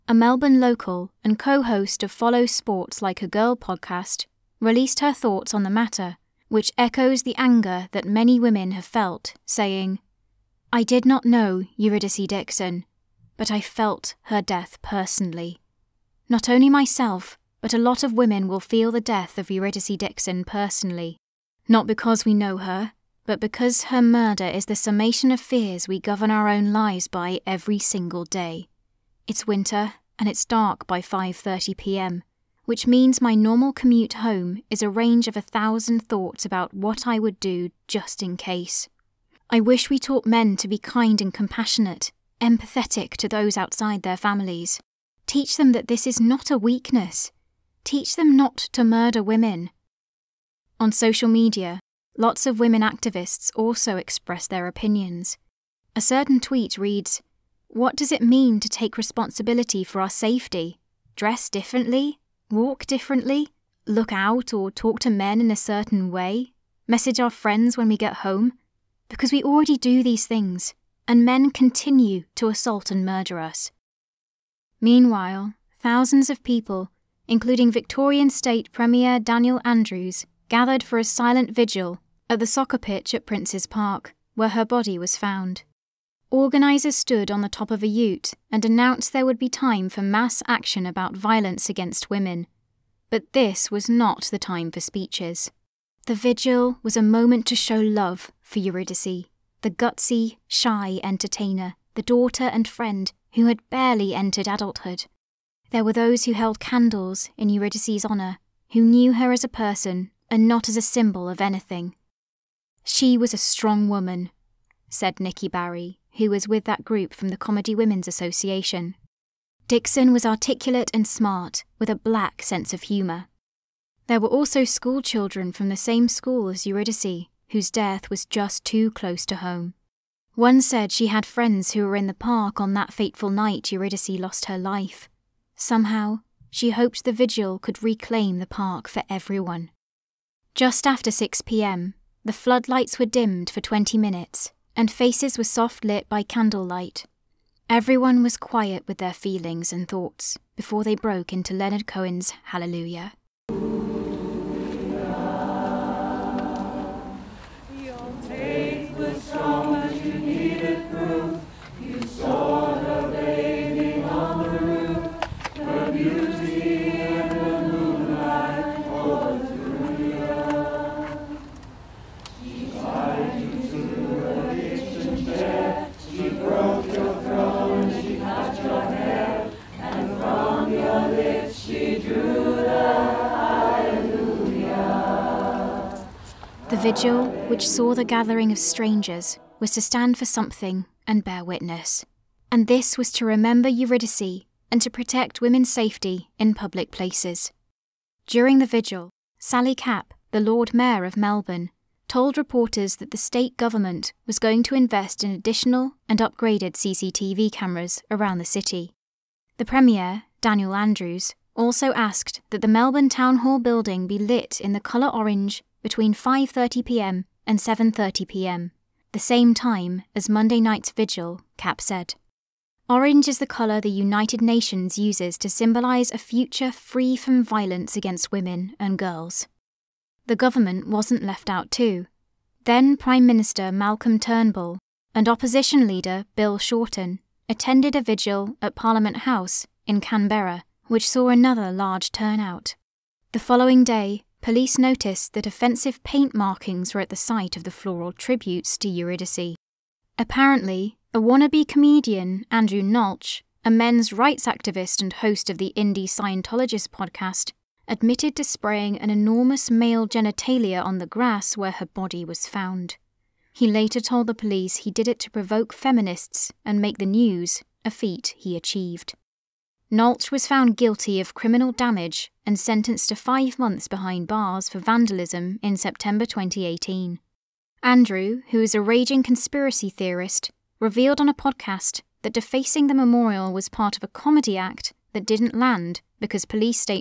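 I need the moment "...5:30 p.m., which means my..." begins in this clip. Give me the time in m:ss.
0:30.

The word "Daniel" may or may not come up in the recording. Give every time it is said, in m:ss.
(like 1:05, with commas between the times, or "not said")
1:19, 3:30.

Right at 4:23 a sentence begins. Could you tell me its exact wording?
He later told the police he did it to provoke feminists and make the news, a feat he achieved.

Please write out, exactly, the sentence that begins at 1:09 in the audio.
Because we already do these things, and men continue to assault and murder us.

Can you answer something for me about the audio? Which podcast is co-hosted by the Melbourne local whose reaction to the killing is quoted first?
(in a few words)
Follow Sports Like a Girl.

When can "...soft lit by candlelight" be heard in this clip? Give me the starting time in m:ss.
2:25.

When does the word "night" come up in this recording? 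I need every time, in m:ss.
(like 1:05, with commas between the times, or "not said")
2:13, 3:40.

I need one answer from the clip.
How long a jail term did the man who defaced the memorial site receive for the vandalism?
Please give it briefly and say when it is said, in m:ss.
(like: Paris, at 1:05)
5 months, at 4:33.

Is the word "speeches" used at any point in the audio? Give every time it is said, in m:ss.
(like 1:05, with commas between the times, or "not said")
1:34.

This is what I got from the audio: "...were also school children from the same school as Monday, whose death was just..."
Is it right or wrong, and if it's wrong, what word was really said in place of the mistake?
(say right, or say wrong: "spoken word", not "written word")
wrong: "Eurydice", not "Monday".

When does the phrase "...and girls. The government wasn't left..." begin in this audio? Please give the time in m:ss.
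3:48.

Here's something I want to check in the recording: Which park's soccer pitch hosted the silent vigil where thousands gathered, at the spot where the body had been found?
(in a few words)
Prince's Park.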